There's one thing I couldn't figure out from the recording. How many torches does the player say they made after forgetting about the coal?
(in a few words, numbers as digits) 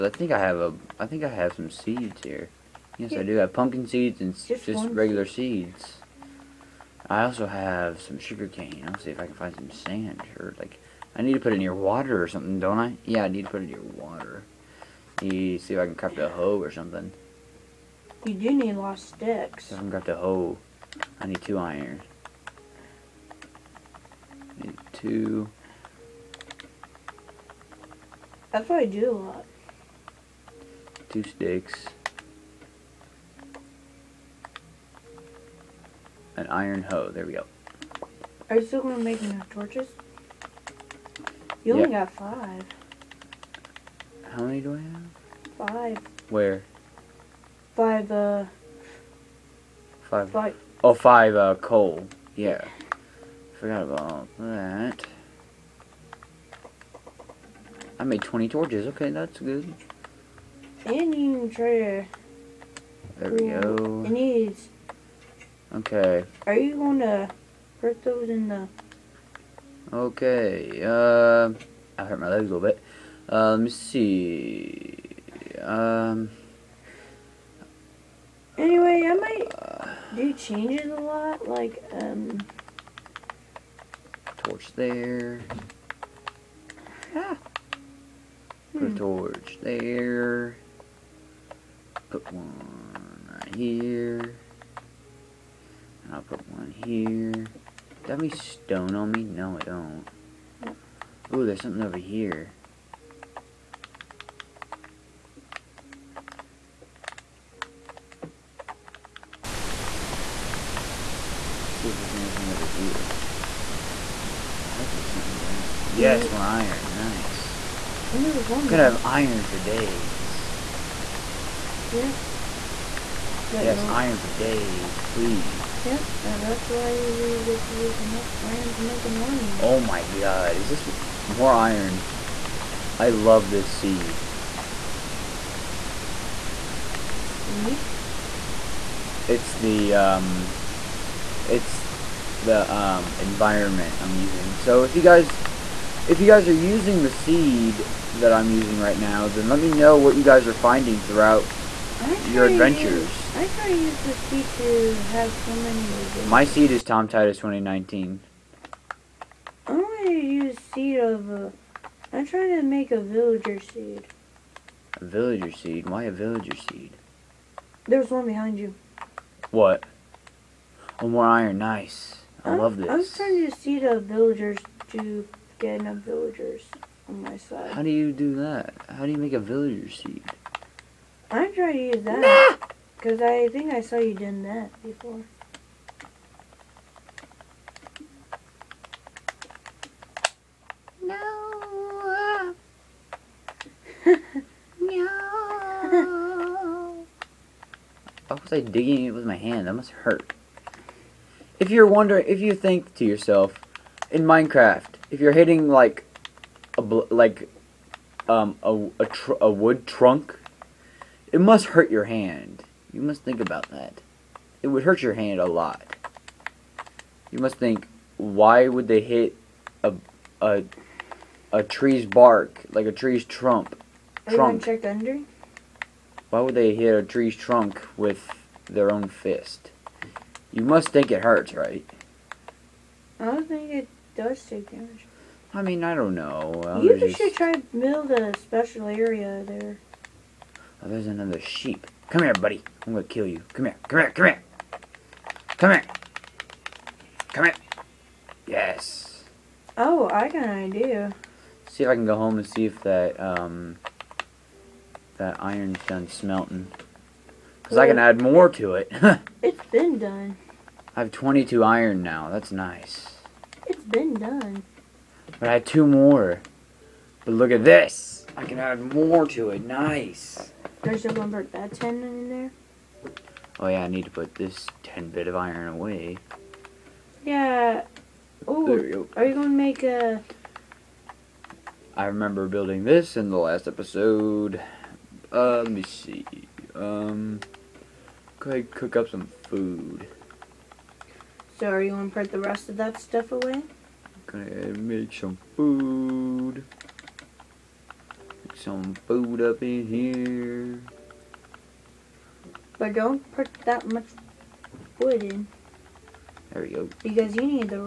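20.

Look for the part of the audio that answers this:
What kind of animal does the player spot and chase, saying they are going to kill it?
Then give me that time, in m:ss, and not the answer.
4:01.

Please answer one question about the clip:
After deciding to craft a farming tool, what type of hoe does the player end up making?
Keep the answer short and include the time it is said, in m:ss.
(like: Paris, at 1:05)
Iron hoe, at 0:36.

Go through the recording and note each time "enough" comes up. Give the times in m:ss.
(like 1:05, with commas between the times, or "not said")
0:39, 2:07, 2:55.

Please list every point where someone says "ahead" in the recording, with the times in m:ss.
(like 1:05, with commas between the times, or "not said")
4:48, 4:54.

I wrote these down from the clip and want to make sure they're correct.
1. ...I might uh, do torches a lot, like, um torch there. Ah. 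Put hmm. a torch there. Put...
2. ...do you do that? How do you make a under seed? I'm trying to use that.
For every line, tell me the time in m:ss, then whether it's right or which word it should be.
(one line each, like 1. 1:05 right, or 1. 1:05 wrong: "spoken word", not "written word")
1. 1:19 wrong: "changes", not "torches"
2. 2:57 wrong: "villager", not "under".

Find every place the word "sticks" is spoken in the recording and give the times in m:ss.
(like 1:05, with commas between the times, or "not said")
0:18, 0:31.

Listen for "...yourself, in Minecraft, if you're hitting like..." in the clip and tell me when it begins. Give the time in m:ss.
3:23.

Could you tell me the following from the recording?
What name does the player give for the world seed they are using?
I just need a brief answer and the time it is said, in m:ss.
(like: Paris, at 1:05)
Tom Titus 2019, at 2:36.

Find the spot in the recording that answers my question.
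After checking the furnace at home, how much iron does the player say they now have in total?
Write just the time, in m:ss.
4:21.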